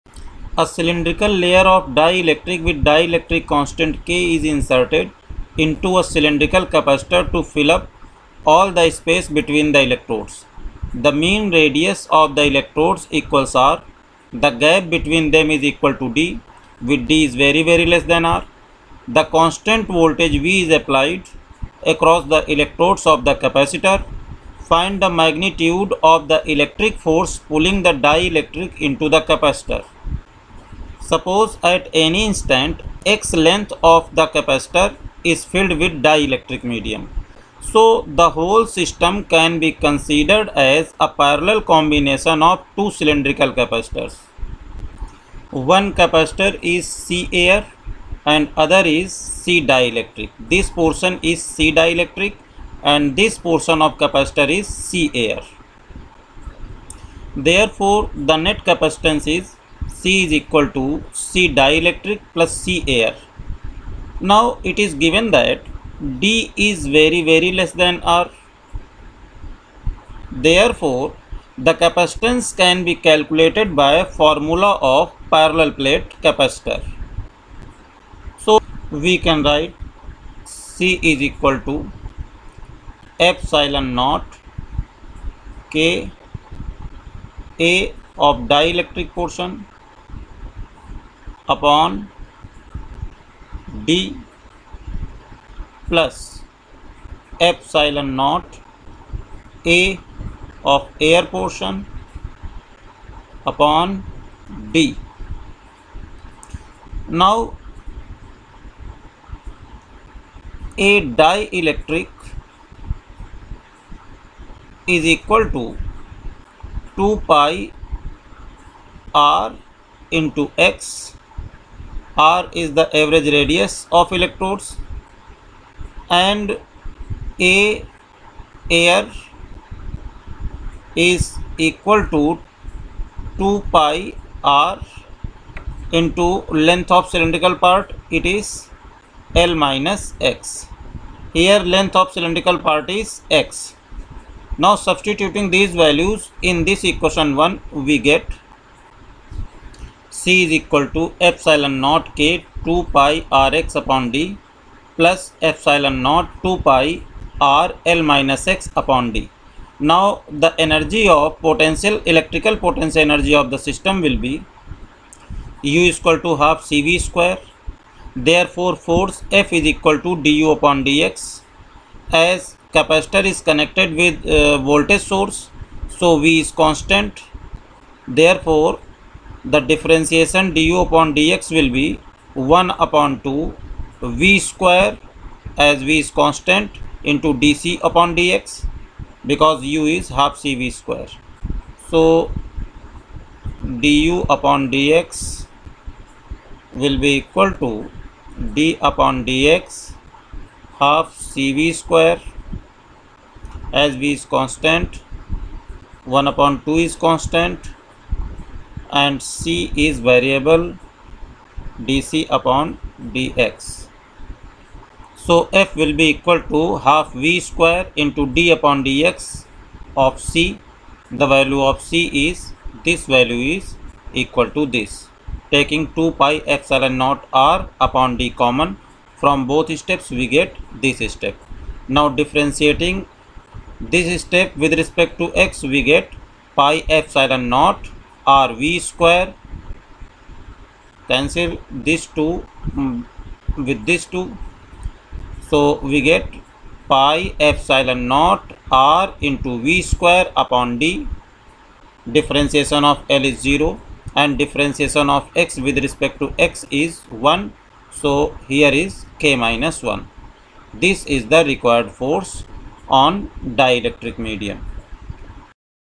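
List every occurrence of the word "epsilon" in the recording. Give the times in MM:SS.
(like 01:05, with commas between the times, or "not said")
01:23, 01:37, 03:46, 03:56, 04:07.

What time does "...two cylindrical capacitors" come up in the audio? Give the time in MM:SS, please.
00:42.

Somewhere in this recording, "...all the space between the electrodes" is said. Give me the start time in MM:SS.
00:08.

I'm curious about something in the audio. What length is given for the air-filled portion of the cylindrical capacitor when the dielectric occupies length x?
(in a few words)
L minus x.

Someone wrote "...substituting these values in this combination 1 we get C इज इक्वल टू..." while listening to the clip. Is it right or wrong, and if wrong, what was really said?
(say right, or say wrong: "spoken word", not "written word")
wrong: "equation", not "combination".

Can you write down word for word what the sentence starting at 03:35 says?
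So f will be equal to half v square into d upon dx of c.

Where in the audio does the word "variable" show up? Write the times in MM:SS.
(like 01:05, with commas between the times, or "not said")
03:29.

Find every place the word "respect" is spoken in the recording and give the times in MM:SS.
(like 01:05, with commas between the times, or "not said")
03:54, 04:15.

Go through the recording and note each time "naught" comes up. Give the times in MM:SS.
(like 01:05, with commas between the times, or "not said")
01:23, 01:38, 03:46, 03:57, 04:08.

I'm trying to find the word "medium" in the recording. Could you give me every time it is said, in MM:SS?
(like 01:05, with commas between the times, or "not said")
00:36, 04:24.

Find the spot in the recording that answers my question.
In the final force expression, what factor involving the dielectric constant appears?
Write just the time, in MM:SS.
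04:19.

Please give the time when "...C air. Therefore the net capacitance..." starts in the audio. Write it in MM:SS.
00:54.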